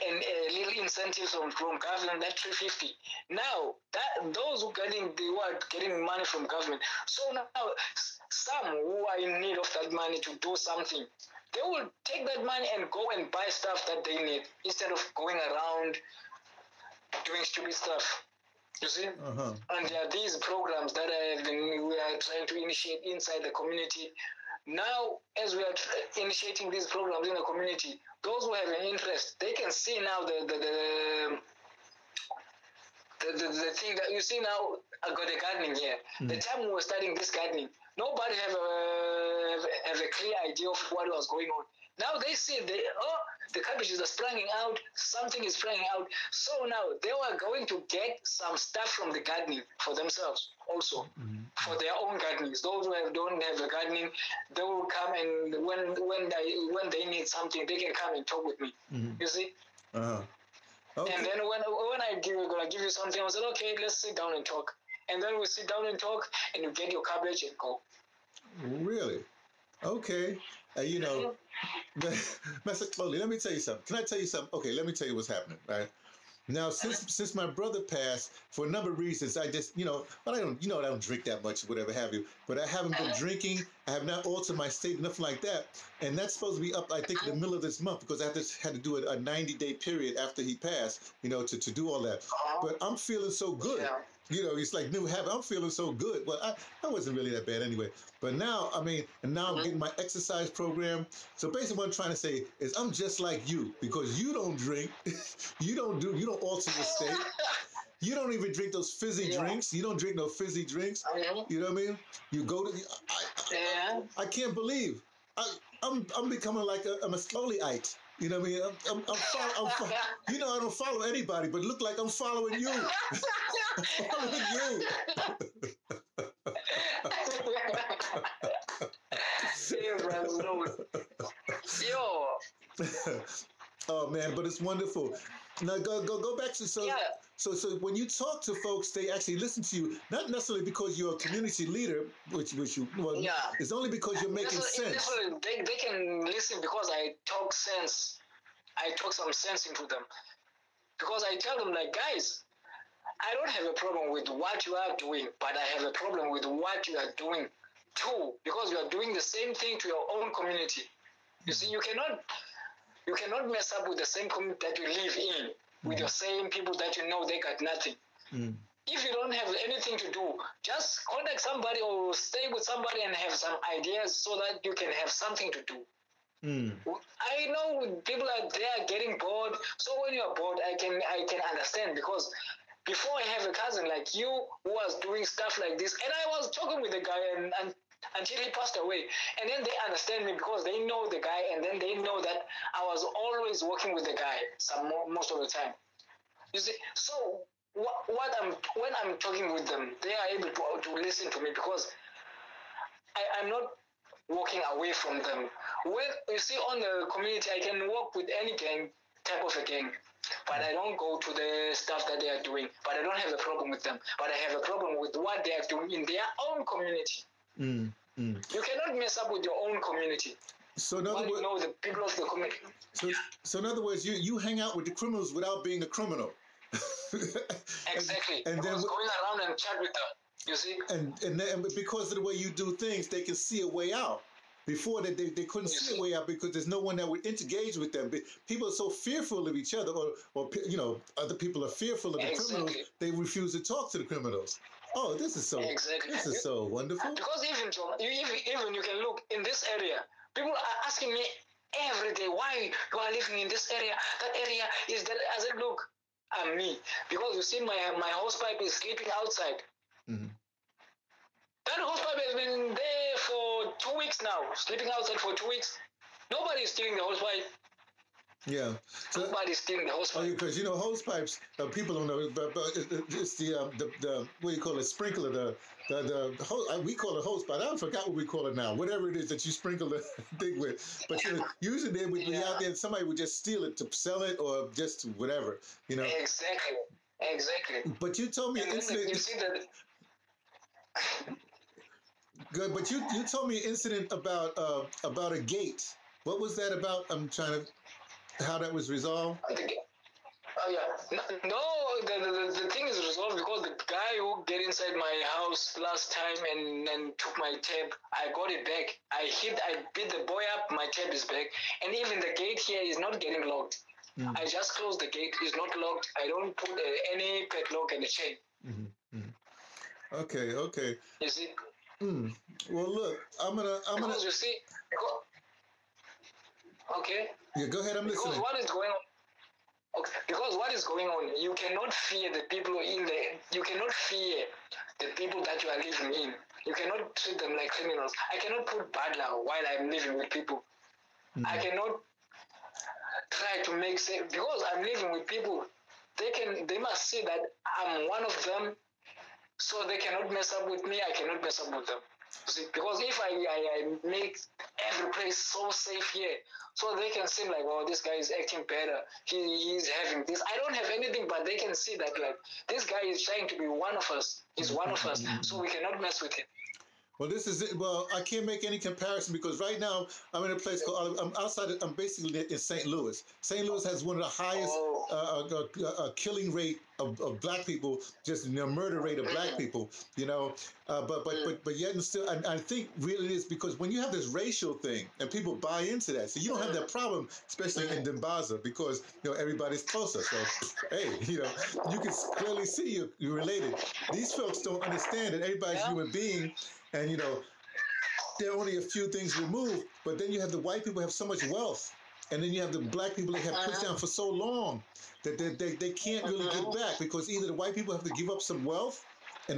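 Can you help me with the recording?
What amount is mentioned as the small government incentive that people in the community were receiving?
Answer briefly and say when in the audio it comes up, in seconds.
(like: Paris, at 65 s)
350, at 2 s.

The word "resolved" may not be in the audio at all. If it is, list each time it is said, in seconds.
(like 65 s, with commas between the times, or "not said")
298 s, 302 s.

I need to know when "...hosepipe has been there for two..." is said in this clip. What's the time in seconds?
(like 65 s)
261 s.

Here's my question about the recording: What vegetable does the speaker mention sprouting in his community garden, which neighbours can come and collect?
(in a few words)
Cabbages.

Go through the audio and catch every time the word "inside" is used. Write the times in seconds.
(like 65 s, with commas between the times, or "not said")
23 s, 304 s.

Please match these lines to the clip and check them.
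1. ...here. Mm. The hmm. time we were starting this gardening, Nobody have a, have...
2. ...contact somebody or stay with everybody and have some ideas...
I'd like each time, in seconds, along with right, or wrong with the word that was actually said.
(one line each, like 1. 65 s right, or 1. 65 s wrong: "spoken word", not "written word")
1. 35 s right
2. 171 s wrong: "somebody", not "everybody".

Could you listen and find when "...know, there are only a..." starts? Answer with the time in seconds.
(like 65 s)
397 s.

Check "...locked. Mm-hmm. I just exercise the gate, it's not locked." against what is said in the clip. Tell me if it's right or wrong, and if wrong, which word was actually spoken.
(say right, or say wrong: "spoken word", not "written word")
wrong: "close", not "exercise".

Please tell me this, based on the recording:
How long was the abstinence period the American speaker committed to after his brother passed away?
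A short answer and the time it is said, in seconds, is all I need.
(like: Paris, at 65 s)
90 days, at 89 s.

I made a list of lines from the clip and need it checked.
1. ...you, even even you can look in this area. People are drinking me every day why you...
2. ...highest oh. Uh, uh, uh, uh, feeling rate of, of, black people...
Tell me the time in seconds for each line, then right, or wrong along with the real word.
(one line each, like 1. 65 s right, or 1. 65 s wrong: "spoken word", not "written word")
1. 247 s wrong: "asking", not "drinking"
2. 374 s wrong: "killing", not "feeling".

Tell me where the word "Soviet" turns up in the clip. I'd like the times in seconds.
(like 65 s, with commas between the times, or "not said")
not said.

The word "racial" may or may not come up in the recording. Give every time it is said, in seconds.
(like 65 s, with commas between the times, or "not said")
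384 s.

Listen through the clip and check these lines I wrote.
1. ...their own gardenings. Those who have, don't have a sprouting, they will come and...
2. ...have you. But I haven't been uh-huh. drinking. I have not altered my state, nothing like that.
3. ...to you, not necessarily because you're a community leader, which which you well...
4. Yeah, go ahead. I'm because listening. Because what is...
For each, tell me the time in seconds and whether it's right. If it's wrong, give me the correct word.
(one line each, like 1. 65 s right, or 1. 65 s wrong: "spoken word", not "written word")
1. 51 s wrong: "gardening", not "sprouting"
2. 81 s right
3. 139 s right
4. 327 s right.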